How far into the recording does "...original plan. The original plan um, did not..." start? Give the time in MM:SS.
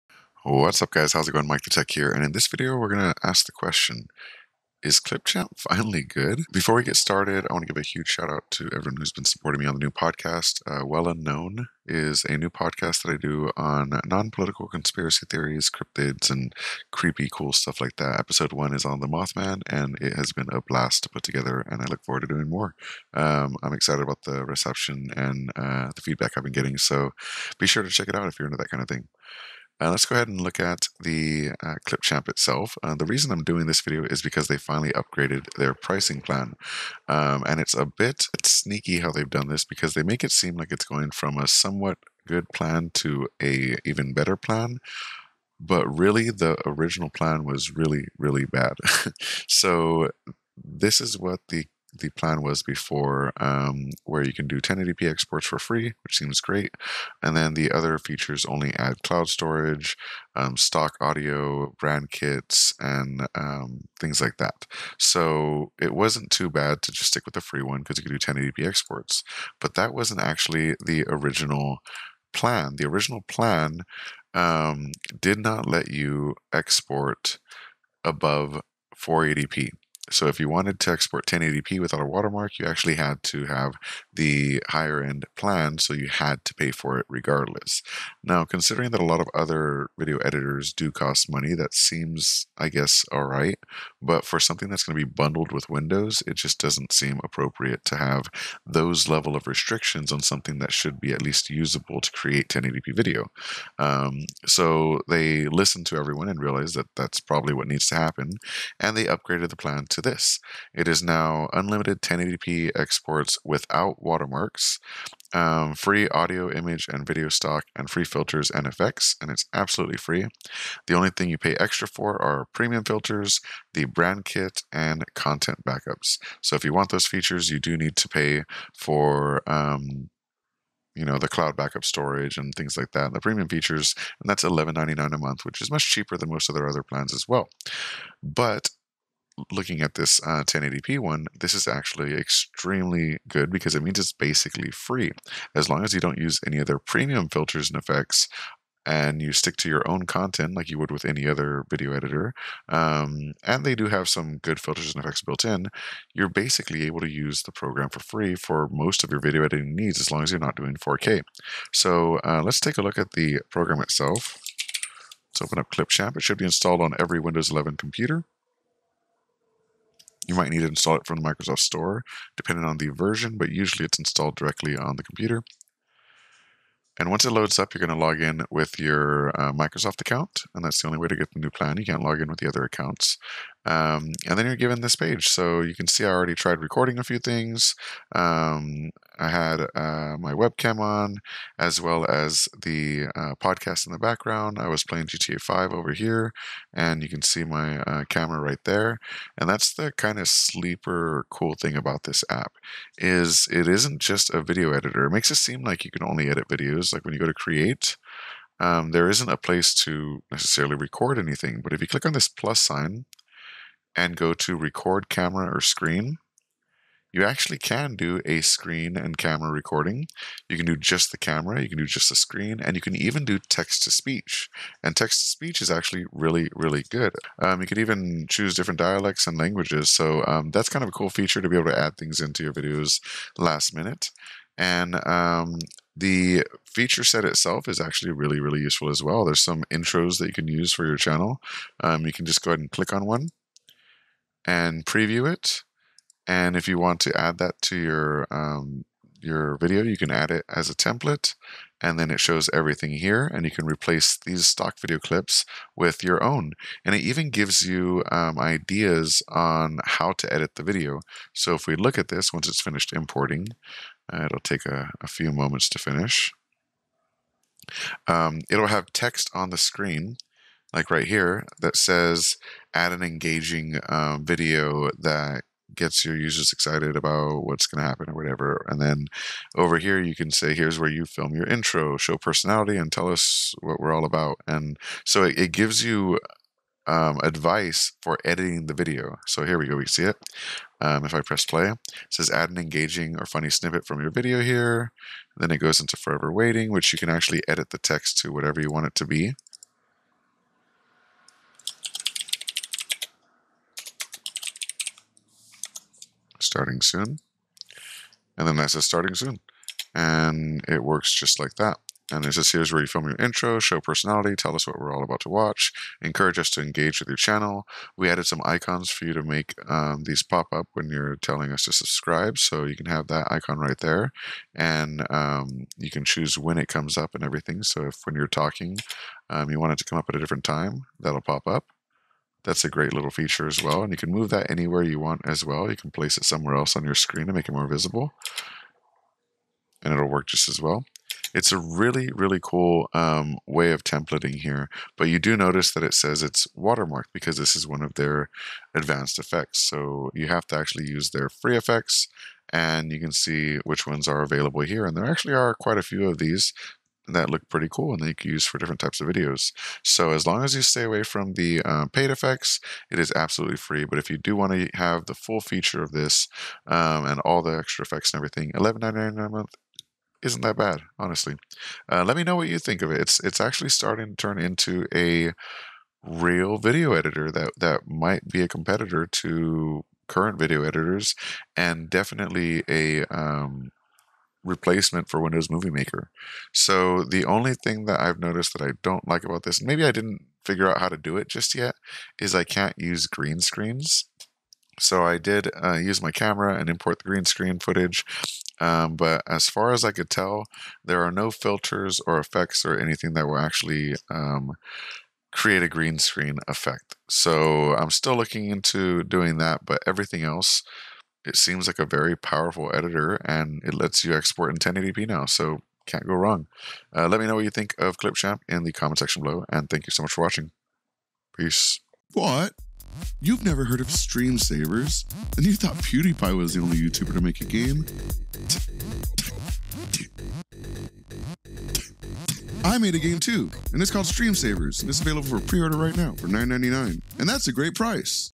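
01:11.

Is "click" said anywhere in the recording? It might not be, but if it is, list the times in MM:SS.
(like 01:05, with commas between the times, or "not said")
03:31, 04:02.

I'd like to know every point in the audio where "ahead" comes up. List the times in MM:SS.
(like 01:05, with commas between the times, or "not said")
00:30, 04:02.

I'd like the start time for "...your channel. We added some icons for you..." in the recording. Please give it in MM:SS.
05:17.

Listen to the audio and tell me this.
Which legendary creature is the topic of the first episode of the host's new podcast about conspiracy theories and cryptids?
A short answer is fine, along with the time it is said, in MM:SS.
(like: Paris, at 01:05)
Mothman, at 00:18.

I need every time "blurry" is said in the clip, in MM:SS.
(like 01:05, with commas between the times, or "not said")
not said.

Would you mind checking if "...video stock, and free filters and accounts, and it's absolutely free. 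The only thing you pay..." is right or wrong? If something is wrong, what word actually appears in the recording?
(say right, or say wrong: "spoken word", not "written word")
wrong: "effects", not "accounts".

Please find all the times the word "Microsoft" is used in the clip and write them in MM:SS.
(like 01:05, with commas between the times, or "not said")
02:51, 02:59.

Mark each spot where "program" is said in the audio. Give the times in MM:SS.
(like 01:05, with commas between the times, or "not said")
02:37, 02:43.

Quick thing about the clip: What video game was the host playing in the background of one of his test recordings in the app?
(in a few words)
GTA 5.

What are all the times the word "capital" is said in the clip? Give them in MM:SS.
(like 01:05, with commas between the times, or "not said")
not said.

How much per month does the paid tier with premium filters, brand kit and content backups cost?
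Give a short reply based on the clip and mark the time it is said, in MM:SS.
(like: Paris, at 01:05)
$11.99, at 02:14.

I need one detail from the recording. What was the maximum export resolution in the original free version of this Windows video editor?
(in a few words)
480p.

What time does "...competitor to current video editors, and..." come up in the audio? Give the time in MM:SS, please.
06:18.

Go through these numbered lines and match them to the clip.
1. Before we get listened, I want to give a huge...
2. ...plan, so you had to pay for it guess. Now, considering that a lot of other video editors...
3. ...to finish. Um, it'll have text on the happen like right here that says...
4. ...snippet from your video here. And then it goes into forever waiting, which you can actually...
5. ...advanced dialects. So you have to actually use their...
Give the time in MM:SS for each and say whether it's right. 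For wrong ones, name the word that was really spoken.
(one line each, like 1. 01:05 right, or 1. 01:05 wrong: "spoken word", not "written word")
1. 00:06 wrong: "started", not "listened"
2. 01:25 wrong: "regardless", not "guess"
3. 04:25 wrong: "screen", not "happen"
4. 04:53 right
5. 05:48 wrong: "effects", not "dialects".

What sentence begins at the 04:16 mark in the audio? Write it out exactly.
And it even gives you um, ideas on how to edit the video.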